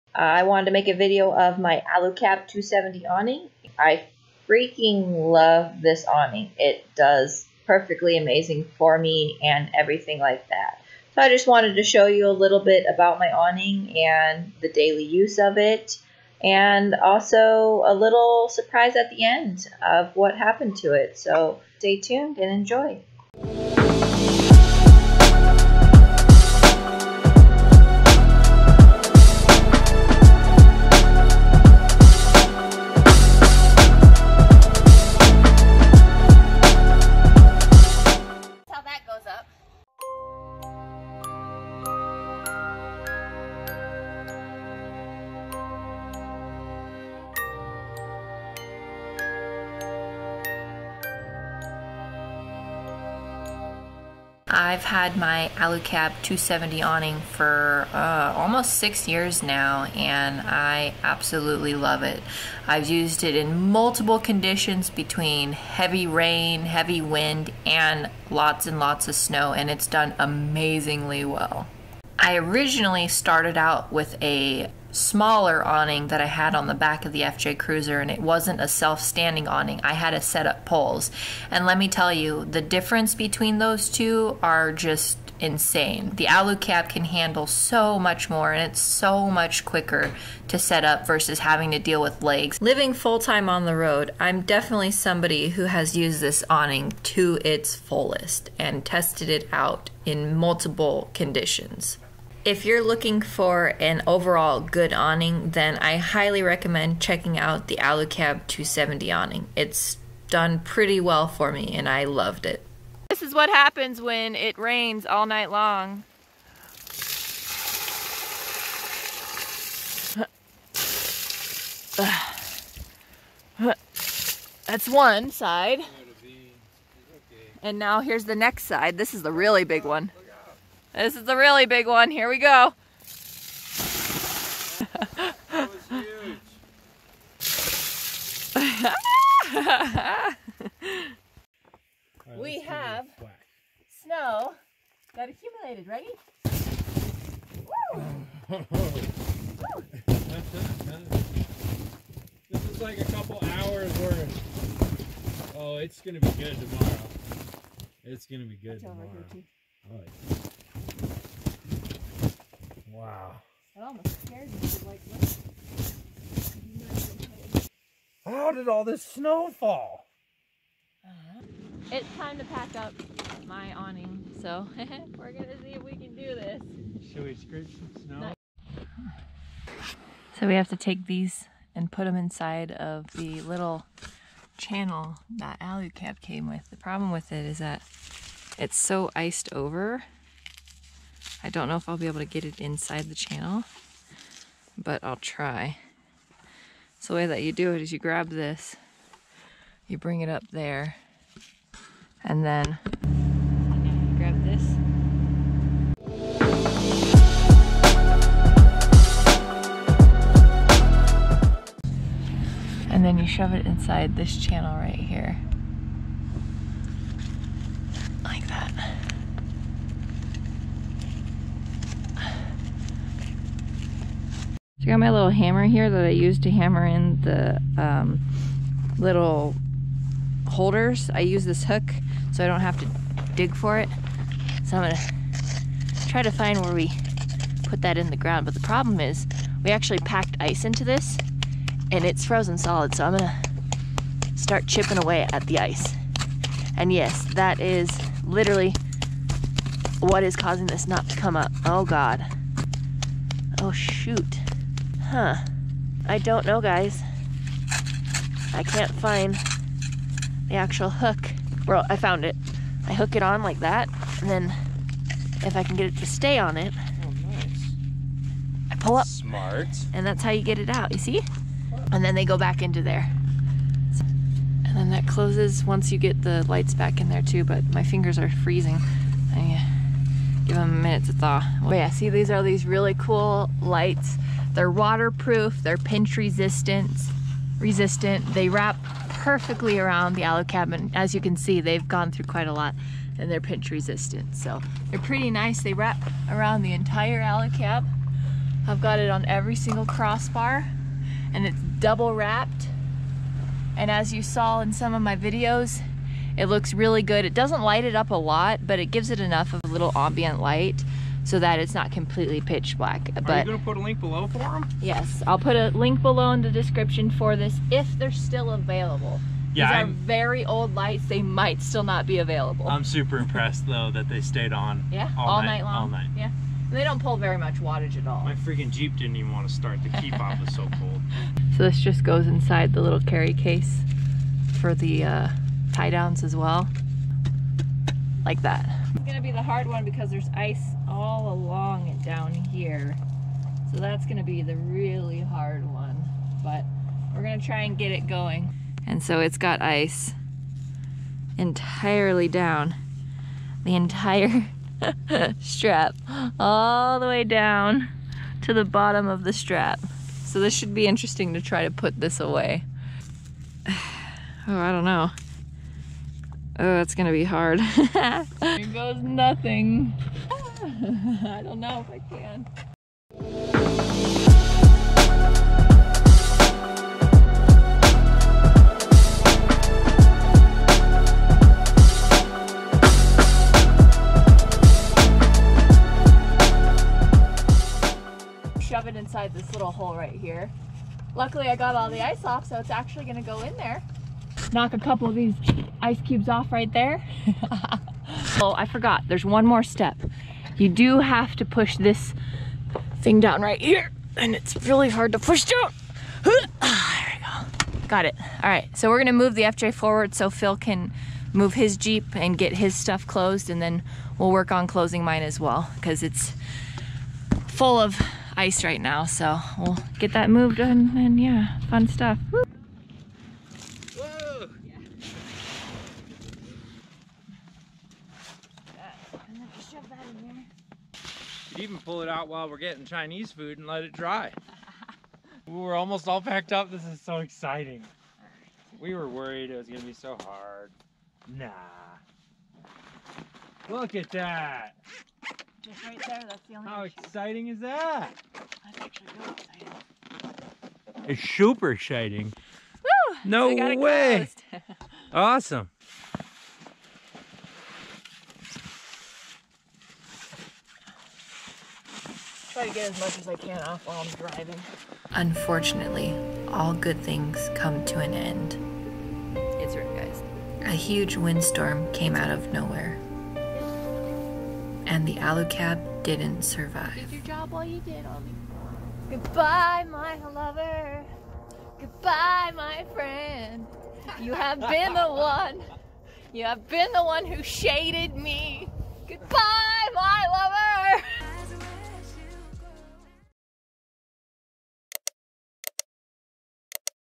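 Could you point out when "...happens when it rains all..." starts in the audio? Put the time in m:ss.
1:53.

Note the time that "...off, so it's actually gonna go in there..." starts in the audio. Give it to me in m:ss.
6:32.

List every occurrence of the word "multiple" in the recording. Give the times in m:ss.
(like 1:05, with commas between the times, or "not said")
1:03, 1:40.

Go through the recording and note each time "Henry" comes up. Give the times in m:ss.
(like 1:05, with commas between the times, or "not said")
not said.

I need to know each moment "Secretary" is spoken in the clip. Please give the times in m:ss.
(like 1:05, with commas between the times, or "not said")
not said.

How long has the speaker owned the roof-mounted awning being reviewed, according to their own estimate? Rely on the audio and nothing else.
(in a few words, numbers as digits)
almost 6 years.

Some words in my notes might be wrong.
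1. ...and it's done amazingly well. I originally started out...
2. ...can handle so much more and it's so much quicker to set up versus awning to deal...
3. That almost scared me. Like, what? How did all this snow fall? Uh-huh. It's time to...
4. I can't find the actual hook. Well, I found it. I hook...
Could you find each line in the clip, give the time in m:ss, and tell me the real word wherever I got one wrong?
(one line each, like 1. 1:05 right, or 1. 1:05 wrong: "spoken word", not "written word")
1. 1:09 right
2. 1:26 wrong: "having", not "awning"
3. 2:43 right
4. 4:18 right.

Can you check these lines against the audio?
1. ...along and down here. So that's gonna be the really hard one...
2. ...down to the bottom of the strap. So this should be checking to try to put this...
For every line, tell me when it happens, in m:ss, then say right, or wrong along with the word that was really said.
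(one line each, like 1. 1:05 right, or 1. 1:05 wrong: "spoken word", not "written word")
1. 5:41 right
2. 5:57 wrong: "interesting", not "checking".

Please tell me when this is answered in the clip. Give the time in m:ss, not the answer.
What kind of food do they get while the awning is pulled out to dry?
7:12.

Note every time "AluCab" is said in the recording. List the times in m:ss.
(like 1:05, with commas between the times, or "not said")
0:01, 0:55, 1:47, 3:05.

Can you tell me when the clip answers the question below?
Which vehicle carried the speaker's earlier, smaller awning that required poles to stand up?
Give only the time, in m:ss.
1:17.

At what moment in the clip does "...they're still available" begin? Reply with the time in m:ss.
5:17.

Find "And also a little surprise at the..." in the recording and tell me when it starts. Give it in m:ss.
0:16.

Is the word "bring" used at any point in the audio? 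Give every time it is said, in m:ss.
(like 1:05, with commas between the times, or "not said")
3:19.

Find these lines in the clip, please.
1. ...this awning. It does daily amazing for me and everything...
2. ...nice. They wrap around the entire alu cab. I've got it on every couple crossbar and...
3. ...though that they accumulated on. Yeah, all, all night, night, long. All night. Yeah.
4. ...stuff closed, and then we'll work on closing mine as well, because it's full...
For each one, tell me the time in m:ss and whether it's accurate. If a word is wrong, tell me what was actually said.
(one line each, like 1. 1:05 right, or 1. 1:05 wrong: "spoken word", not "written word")
1. 0:05 wrong: "perfectly", not "daily"
2. 4:55 wrong: "single", not "couple"
3. 5:23 wrong: "stayed", not "accumulated"
4. 6:52 right.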